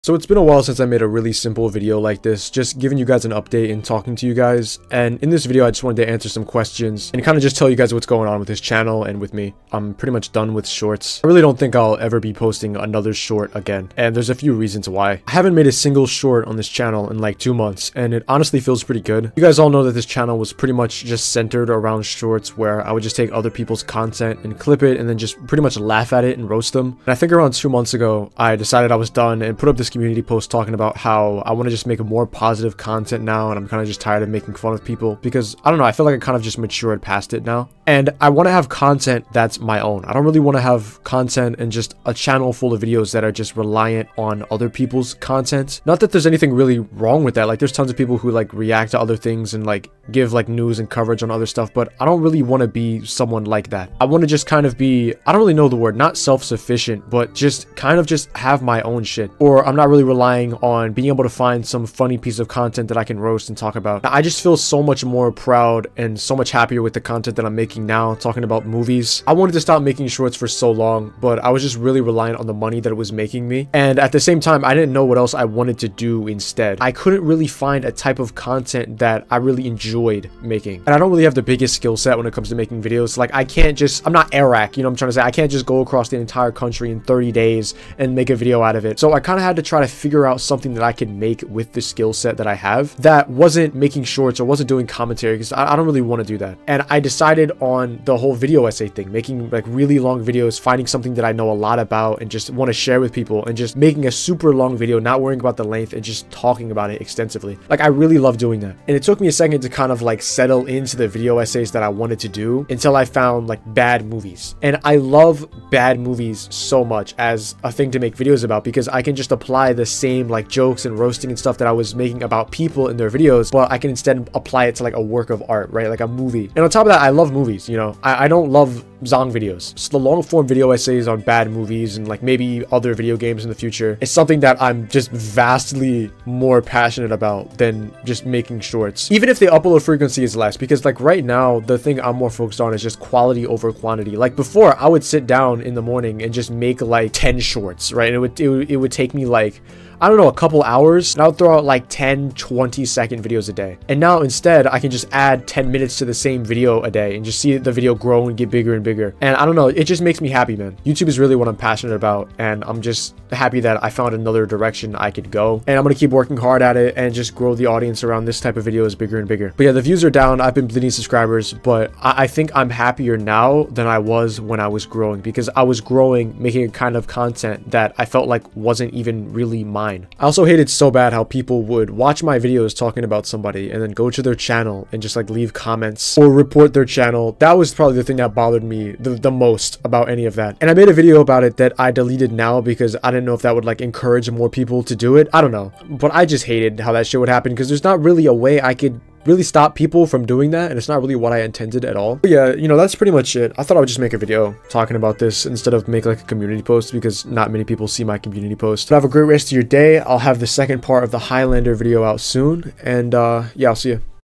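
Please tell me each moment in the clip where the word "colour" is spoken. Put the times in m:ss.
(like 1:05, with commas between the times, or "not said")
not said.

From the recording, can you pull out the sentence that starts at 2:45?
And I'm gonna keep working hard at it and just grow the audience around this type of videos bigger and bigger.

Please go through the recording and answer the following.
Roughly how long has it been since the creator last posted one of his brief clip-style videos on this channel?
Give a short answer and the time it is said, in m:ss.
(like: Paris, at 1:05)
2 months, at 0:17.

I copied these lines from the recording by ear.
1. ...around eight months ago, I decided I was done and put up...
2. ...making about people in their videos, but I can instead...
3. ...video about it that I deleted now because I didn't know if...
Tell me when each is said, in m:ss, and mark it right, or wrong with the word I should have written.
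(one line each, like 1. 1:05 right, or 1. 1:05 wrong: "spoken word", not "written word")
1. 0:27 wrong: "two", not "eight"
2. 2:01 right
3. 3:10 right.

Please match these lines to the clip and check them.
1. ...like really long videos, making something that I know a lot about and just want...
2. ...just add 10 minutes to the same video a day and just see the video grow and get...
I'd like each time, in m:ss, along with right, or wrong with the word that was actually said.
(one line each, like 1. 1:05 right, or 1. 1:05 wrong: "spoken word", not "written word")
1. 1:39 wrong: "finding", not "making"
2. 2:34 right.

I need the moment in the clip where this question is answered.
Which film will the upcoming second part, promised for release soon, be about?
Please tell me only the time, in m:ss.
3:31.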